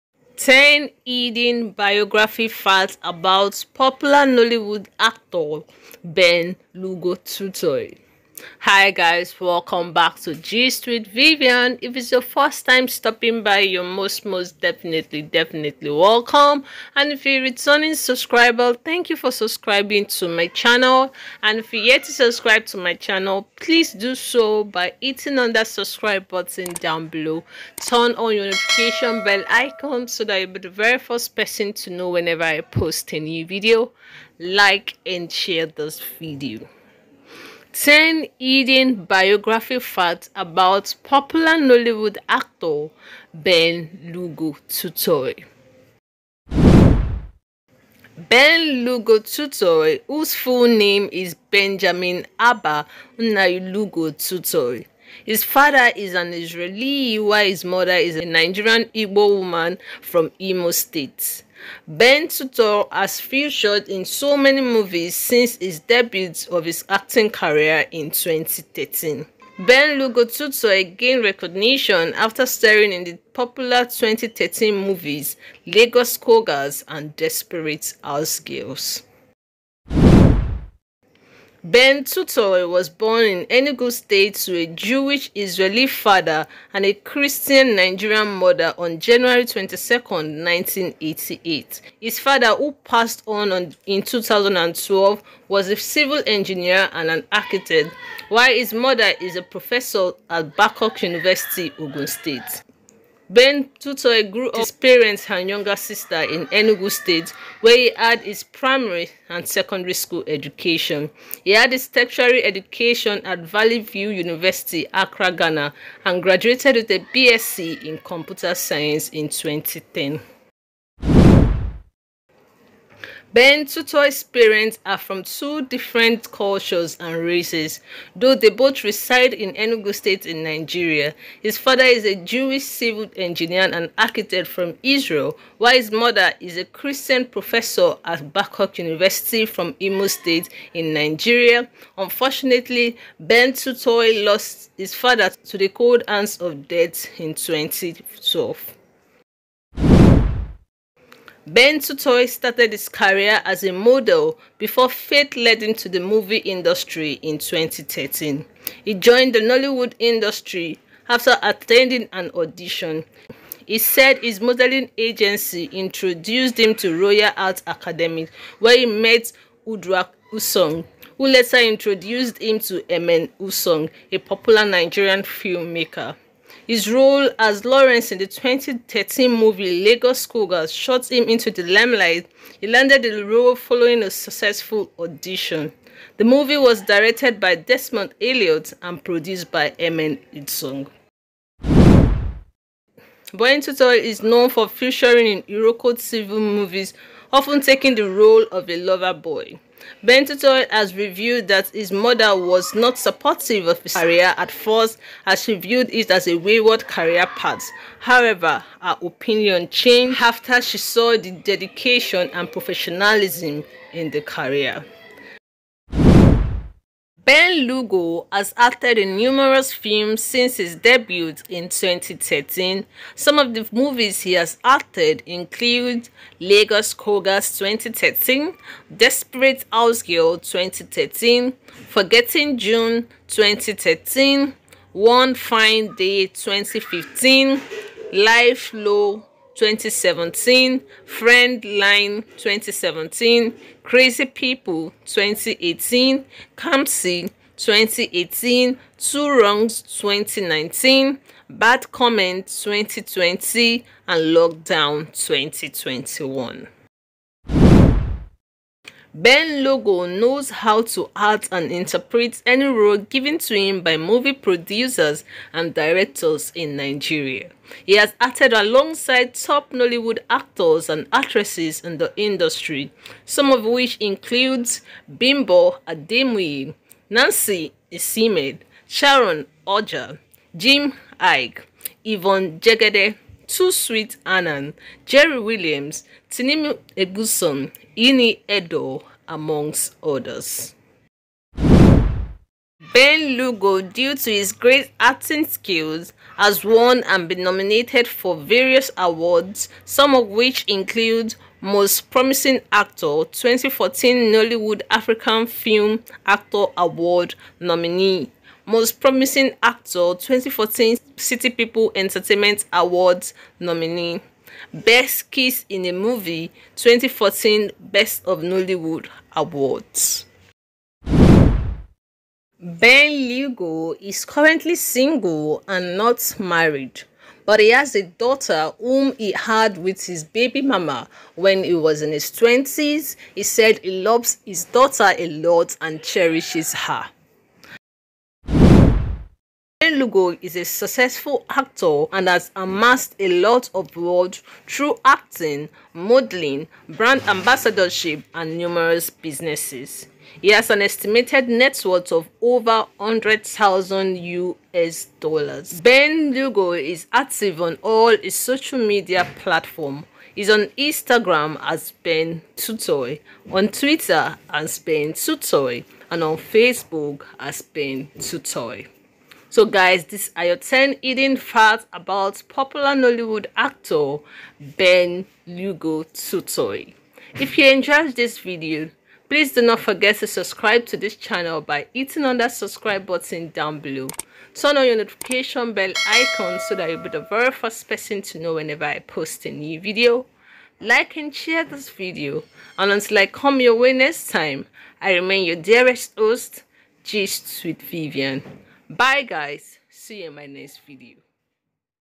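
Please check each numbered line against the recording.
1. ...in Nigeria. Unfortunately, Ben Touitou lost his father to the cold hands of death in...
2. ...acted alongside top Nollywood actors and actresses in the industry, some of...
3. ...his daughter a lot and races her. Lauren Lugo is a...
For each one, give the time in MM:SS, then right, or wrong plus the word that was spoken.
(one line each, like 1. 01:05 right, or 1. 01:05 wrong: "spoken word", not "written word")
1. 02:20 right
2. 04:28 right
3. 05:34 wrong: "cherishes", not "races".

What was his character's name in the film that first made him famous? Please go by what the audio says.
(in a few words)
Lawrence.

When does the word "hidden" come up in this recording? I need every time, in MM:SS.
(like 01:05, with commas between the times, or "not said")
00:01, 00:38, 06:11.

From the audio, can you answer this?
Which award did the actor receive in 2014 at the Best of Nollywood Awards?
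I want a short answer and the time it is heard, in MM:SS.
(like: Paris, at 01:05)
Best Kiss in a Movie, at 05:14.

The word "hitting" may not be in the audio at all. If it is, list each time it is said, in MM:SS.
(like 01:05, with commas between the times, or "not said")
00:25, 06:21.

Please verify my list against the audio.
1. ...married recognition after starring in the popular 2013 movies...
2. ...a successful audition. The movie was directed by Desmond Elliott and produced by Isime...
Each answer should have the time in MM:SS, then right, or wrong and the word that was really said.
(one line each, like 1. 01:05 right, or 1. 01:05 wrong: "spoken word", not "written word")
1. 01:10 wrong: "gained", not "married"
2. 03:04 wrong: "Emem", not "Isime".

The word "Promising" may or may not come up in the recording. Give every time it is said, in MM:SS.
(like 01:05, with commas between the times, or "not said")
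05:02, 05:08.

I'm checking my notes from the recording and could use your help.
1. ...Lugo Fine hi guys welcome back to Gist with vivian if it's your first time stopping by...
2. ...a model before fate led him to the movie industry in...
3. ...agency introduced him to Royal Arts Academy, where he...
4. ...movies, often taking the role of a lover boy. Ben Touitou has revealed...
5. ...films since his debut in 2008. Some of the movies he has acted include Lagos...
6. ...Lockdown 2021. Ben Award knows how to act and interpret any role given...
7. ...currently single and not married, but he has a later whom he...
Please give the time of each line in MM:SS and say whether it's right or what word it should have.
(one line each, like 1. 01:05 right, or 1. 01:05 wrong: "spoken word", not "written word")
1. 00:06 wrong: "Touitou", not "Fine"
2. 02:33 right
3. 02:44 right
4. 03:16 right
5. 03:39 wrong: "2013", not "2008"
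6. 04:14 wrong: "Lugo", not "Award"
7. 05:24 wrong: "daughter", not "later".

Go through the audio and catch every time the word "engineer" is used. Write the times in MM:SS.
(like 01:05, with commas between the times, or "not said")
01:36, 02:13.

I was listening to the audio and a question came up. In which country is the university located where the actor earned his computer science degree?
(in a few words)
Ghana.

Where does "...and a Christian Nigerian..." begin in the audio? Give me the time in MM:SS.
01:26.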